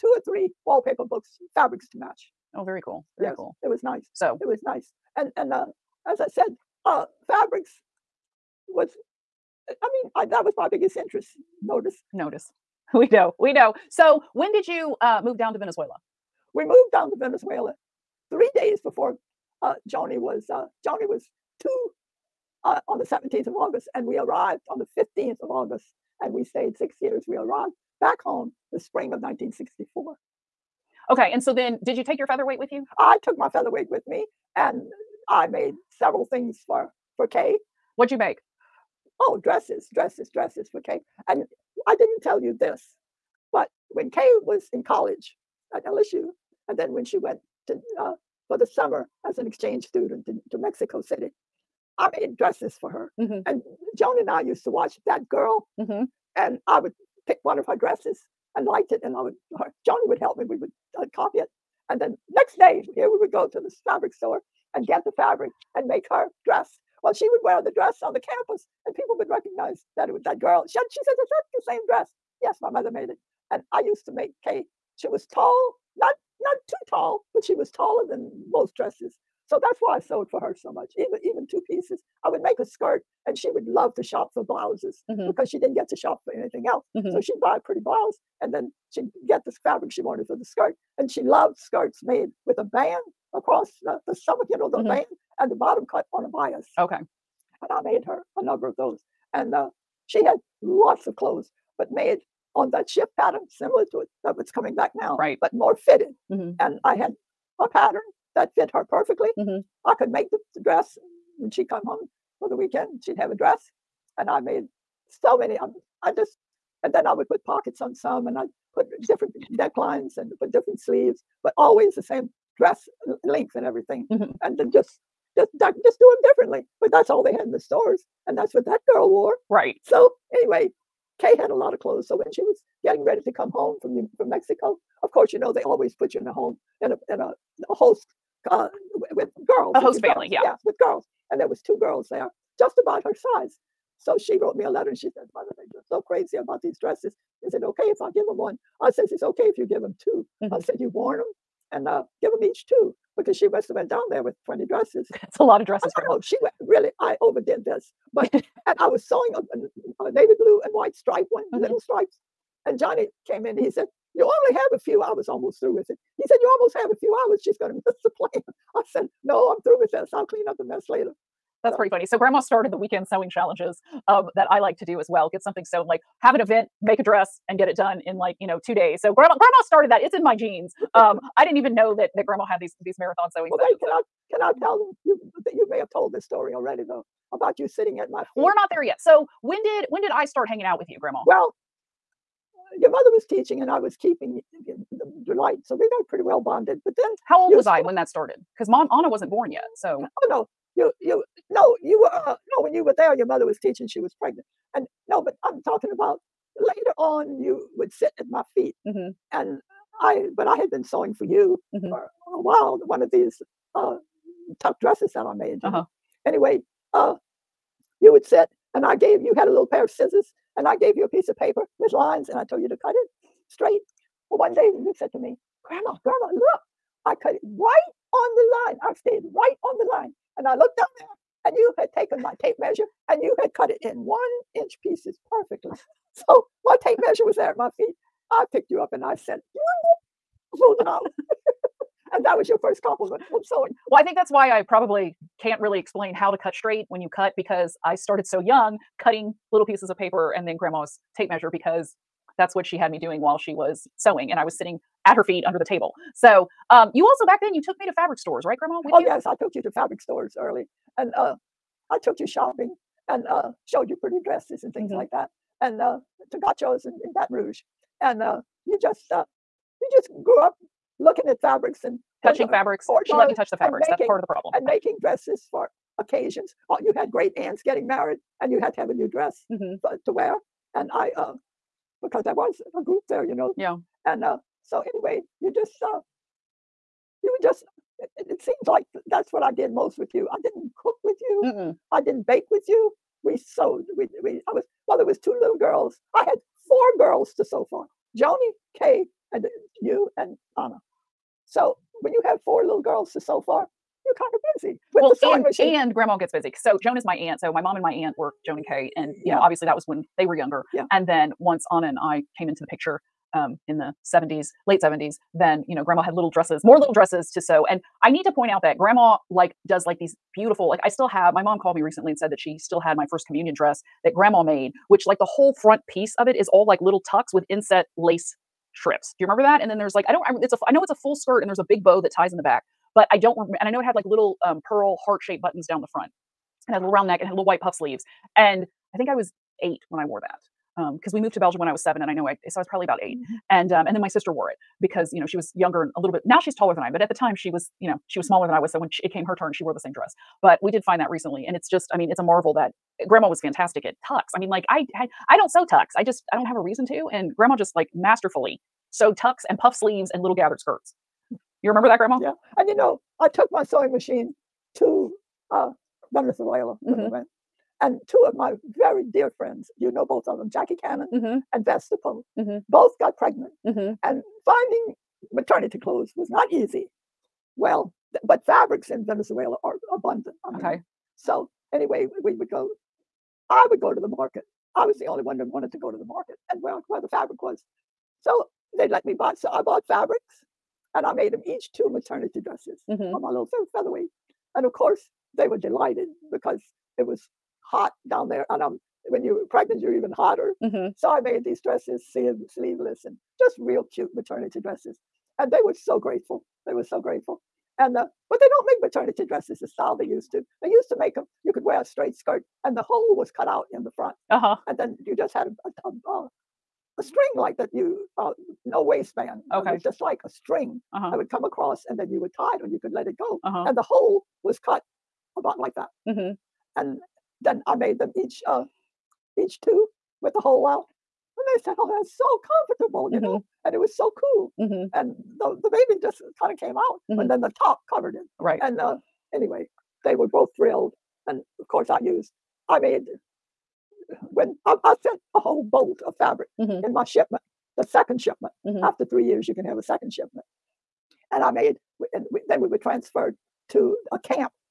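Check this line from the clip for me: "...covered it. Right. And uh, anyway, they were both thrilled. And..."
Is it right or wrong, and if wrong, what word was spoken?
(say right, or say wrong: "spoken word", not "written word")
right.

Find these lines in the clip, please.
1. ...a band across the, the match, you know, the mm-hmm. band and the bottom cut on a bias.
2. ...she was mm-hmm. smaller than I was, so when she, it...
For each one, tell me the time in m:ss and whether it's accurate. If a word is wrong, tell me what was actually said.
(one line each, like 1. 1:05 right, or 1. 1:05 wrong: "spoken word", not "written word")
1. 1:32 wrong: "stomach", not "match"
2. 5:48 right.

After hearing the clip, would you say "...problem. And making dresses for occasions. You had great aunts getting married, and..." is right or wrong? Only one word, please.
right.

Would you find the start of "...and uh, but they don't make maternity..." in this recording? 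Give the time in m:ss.
6:47.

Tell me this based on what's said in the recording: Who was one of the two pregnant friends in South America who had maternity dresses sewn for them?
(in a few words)
Jackie Cannon.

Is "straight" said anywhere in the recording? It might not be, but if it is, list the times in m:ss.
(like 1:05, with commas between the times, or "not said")
3:43, 4:06, 6:51.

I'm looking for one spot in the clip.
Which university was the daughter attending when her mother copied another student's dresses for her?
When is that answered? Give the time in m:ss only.
0:45.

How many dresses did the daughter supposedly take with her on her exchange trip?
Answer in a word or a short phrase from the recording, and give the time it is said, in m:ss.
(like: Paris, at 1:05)
20, at 2:34.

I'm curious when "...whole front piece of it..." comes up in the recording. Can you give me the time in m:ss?
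5:25.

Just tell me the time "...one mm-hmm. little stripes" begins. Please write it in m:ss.
2:41.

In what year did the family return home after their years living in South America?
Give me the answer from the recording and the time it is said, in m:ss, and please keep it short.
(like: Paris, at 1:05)
1964, at 0:29.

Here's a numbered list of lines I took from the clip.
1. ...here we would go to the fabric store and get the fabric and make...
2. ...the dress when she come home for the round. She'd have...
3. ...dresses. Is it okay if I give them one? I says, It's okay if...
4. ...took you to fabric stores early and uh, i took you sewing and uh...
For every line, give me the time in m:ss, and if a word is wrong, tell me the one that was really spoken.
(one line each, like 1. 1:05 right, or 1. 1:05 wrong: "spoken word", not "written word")
1. 1:02 right
2. 1:50 wrong: "weekend", not "round"
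3. 2:26 right
4. 4:19 wrong: "shopping", not "sewing".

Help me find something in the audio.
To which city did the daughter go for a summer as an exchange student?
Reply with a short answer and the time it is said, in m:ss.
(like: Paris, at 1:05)
Mexico City, at 0:50.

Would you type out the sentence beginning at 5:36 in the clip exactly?
And had a little round neck and had little white puff sleeves.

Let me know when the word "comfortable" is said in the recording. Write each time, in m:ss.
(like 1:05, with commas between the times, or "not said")
7:12.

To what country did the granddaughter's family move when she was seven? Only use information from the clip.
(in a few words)
Belgium.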